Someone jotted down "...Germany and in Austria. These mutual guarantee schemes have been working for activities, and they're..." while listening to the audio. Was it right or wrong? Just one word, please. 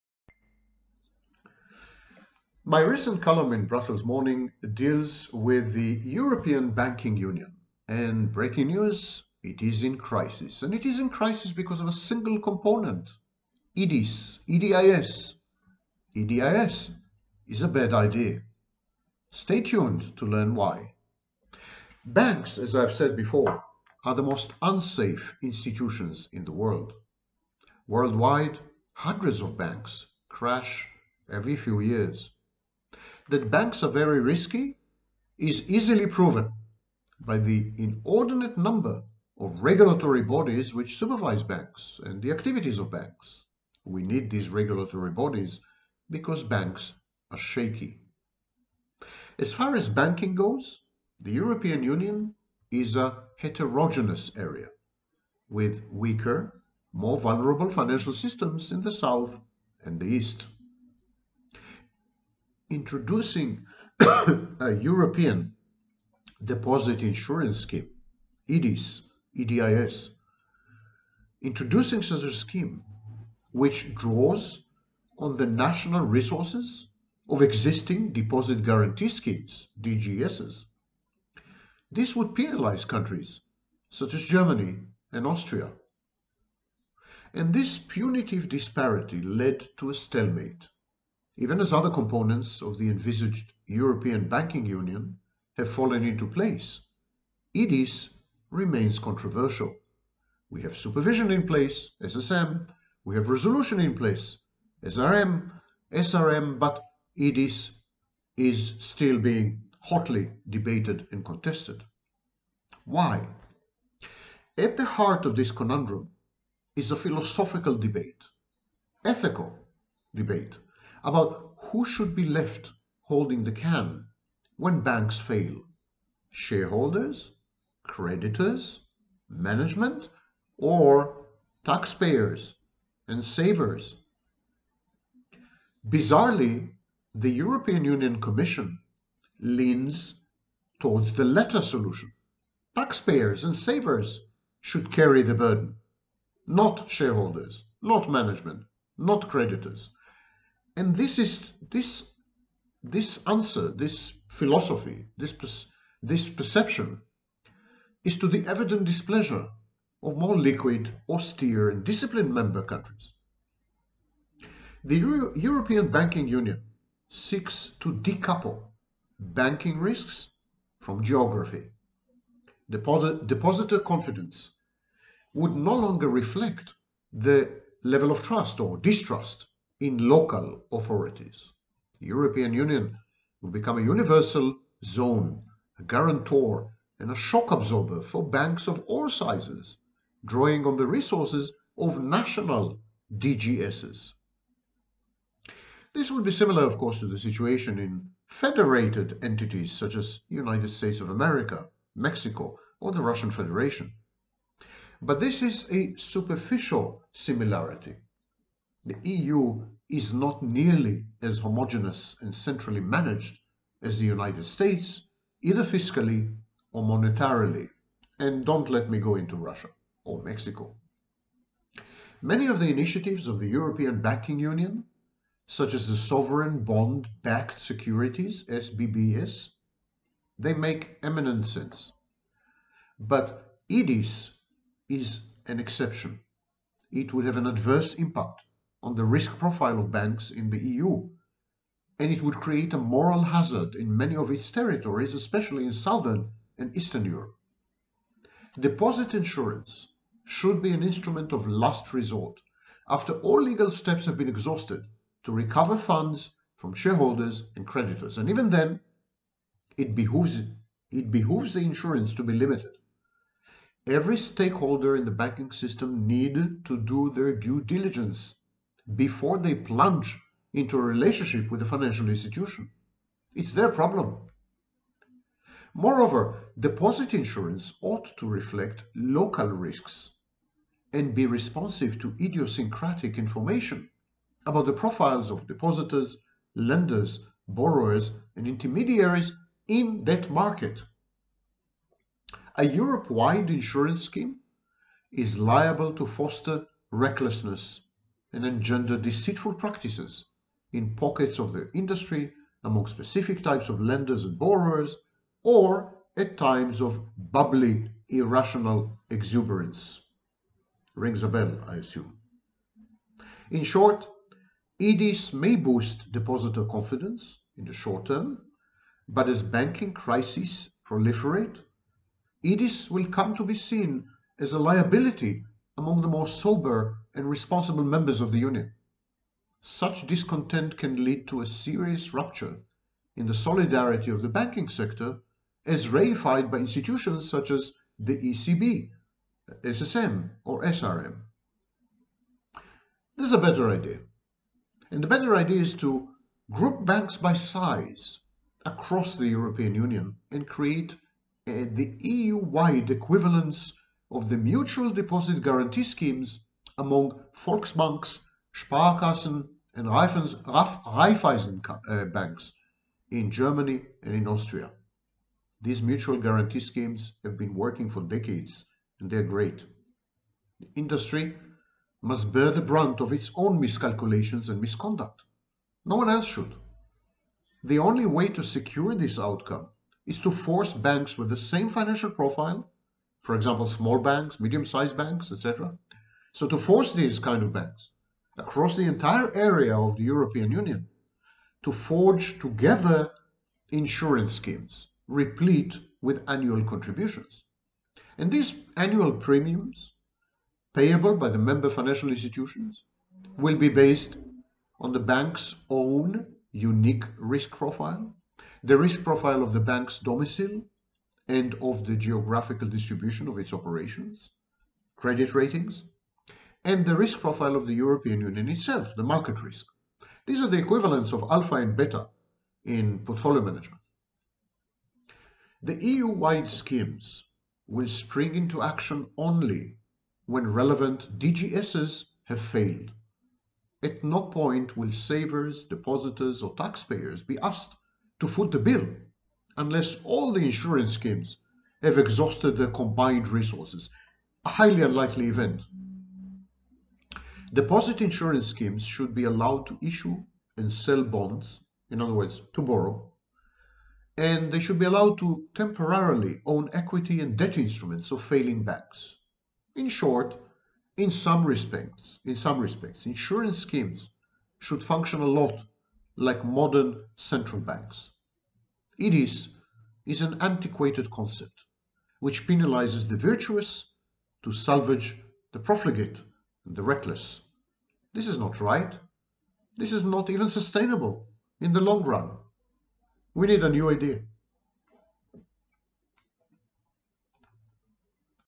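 wrong.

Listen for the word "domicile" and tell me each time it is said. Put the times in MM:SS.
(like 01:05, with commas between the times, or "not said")
06:49.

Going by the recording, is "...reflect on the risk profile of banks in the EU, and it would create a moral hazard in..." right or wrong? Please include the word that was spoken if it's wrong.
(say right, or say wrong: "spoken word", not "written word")
wrong: "impact", not "reflect".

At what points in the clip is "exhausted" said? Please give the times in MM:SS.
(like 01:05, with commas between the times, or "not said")
04:14, 07:21.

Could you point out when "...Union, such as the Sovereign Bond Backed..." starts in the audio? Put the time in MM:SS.
03:44.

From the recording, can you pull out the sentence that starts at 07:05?
The EU-wide schemes will spring into action only when relevant DGSs have failed.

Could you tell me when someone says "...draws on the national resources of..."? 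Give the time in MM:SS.
01:13.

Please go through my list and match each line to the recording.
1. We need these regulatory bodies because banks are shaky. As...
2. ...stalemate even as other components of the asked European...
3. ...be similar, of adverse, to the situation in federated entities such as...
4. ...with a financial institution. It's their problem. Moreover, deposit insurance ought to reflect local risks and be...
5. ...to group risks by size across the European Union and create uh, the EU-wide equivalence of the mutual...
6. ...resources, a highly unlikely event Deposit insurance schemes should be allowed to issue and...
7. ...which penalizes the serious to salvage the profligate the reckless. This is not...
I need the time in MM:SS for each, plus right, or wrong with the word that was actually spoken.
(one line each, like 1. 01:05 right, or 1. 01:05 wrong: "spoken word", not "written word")
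1. 00:43 right
2. 01:29 wrong: "envisaged", not "asked"
3. 03:16 wrong: "course", not "adverse"
4. 04:31 right
5. 05:45 wrong: "banks", not "risks"
6. 07:23 right
7. 07:52 wrong: "virtuous", not "serious".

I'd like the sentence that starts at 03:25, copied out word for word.
But this is a superficial similarity.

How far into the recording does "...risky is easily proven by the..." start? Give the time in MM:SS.
00:34.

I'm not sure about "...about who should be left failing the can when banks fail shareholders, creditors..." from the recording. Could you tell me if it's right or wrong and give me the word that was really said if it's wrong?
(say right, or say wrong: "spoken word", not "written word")
wrong: "holding", not "failing".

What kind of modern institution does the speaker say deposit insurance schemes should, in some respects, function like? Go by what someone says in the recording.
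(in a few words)
Central banks.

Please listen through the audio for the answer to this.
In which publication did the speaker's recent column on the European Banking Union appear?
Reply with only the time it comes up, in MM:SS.
00:03.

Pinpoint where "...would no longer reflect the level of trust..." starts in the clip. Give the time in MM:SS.
02:55.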